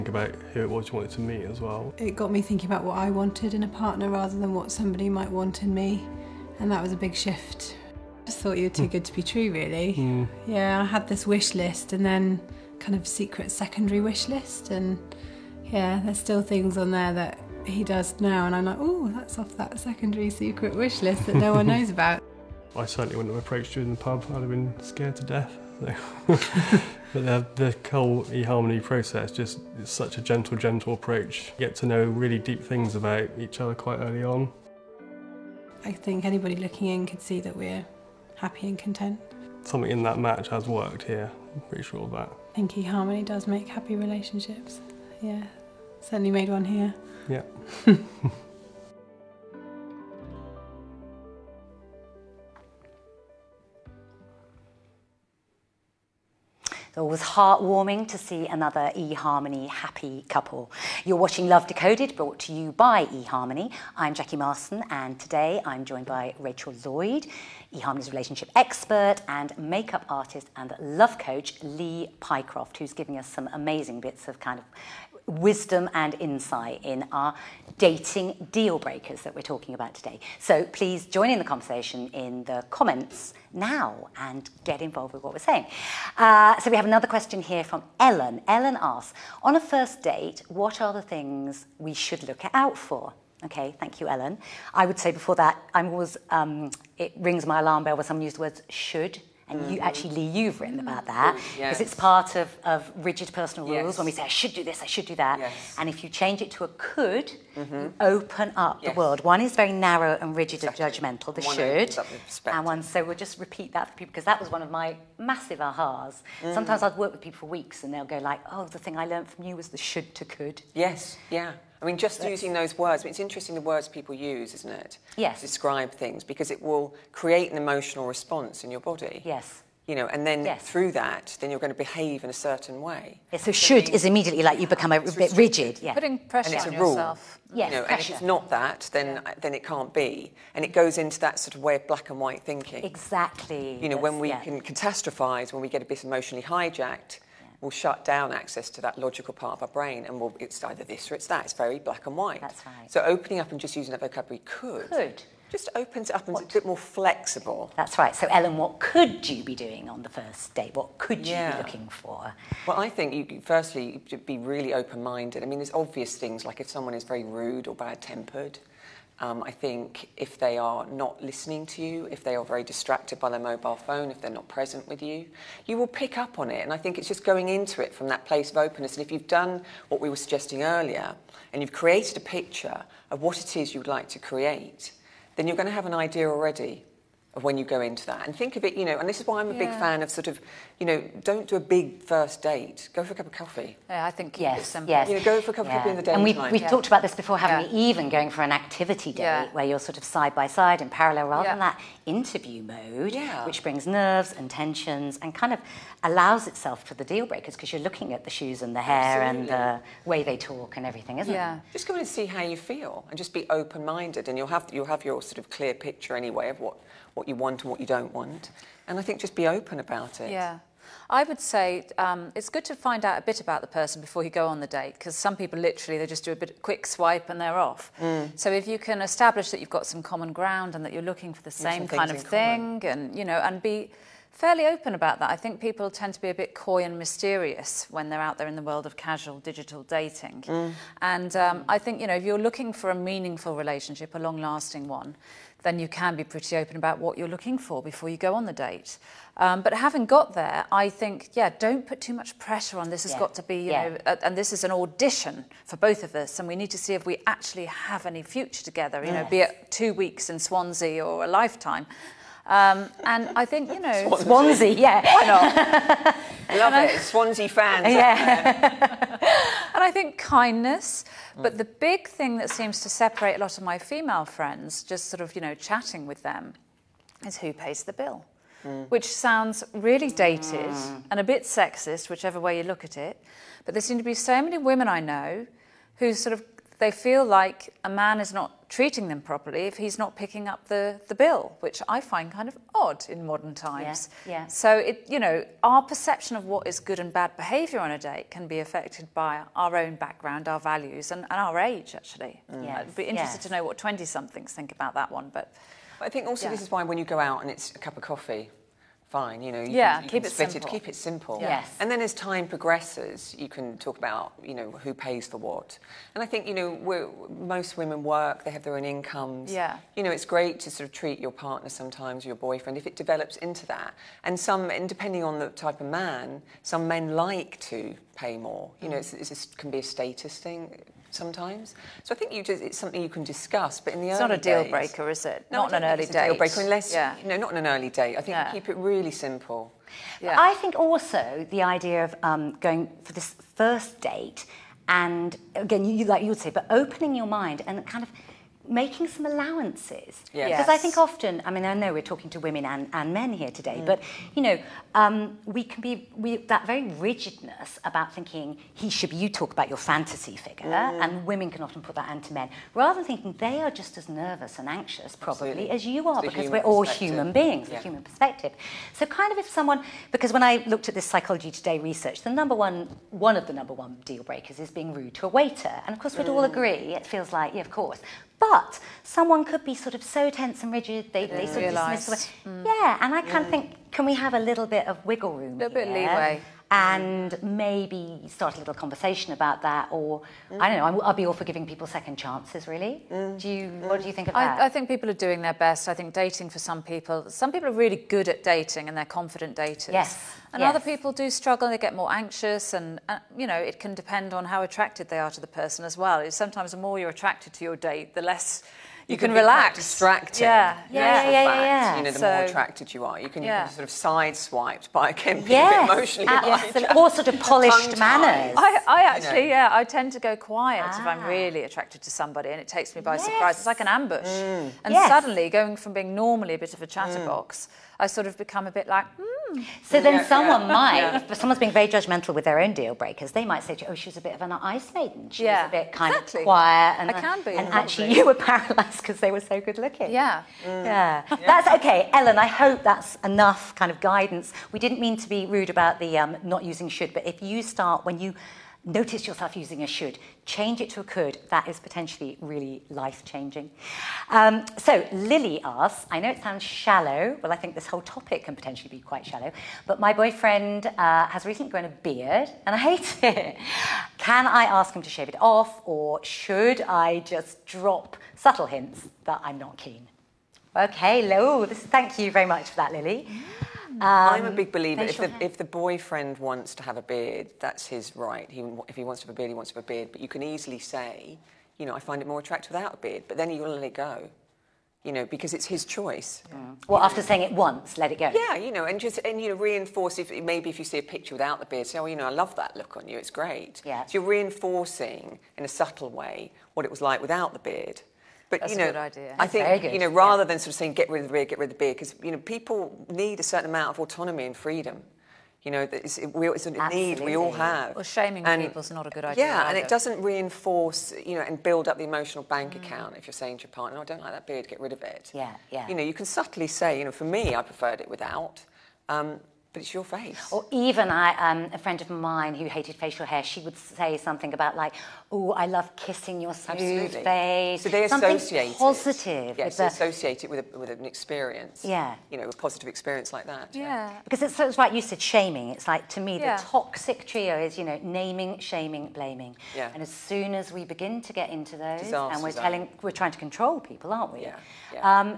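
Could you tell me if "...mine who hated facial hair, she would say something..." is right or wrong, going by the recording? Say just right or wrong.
right.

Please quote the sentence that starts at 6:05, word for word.
as you are, the because we're all human beings, yeah.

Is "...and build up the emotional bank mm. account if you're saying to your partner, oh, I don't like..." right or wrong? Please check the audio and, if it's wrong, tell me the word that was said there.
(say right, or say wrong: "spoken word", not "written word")
right.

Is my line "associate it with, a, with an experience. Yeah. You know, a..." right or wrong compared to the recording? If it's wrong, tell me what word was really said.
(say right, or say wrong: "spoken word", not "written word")
right.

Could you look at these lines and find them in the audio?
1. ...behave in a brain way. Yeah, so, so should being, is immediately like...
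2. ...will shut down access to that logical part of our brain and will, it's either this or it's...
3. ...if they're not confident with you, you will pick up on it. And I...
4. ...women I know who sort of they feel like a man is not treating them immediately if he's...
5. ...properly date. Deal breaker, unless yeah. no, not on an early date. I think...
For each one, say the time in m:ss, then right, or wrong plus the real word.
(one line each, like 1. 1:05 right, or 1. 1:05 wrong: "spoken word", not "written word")
1. 2:11 wrong: "certain", not "brain"
2. 2:27 right
3. 2:54 wrong: "present", not "confident"
4. 4:44 wrong: "properly", not "immediately"
5. 5:35 wrong: "early", not "properly".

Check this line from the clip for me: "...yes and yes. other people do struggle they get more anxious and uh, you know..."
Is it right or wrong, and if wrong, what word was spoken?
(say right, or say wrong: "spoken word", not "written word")
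right.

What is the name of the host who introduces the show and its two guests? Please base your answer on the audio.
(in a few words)
Jacqui Marson.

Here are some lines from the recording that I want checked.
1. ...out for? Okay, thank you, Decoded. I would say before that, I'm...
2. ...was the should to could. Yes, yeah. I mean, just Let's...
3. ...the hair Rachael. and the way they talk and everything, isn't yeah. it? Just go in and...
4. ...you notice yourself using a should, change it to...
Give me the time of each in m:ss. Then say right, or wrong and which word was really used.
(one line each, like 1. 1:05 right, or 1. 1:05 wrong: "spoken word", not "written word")
1. 1:32 wrong: "Ellen", not "Decoded"
2. 1:59 right
3. 3:28 wrong: "Absolutely", not "Rachael"
4. 7:28 right.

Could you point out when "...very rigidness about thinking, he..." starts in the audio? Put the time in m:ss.
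5:56.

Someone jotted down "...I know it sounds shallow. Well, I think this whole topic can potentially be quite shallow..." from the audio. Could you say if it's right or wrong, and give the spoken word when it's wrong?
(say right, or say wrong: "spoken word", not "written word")
right.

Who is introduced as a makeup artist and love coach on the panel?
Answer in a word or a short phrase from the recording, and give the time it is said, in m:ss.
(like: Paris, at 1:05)
Lee Pycroft, at 1:11.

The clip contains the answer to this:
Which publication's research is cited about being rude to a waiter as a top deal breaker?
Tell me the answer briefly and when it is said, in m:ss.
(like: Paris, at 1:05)
Psychology Today, at 6:11.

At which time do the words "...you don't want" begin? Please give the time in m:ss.
3:37.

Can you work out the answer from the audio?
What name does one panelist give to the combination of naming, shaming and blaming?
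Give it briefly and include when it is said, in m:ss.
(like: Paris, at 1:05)
the toxic trio, at 8:56.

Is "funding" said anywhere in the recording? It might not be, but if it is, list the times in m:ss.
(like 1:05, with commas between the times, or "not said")
not said.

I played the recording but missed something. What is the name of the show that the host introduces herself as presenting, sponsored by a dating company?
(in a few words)
Love Decoded.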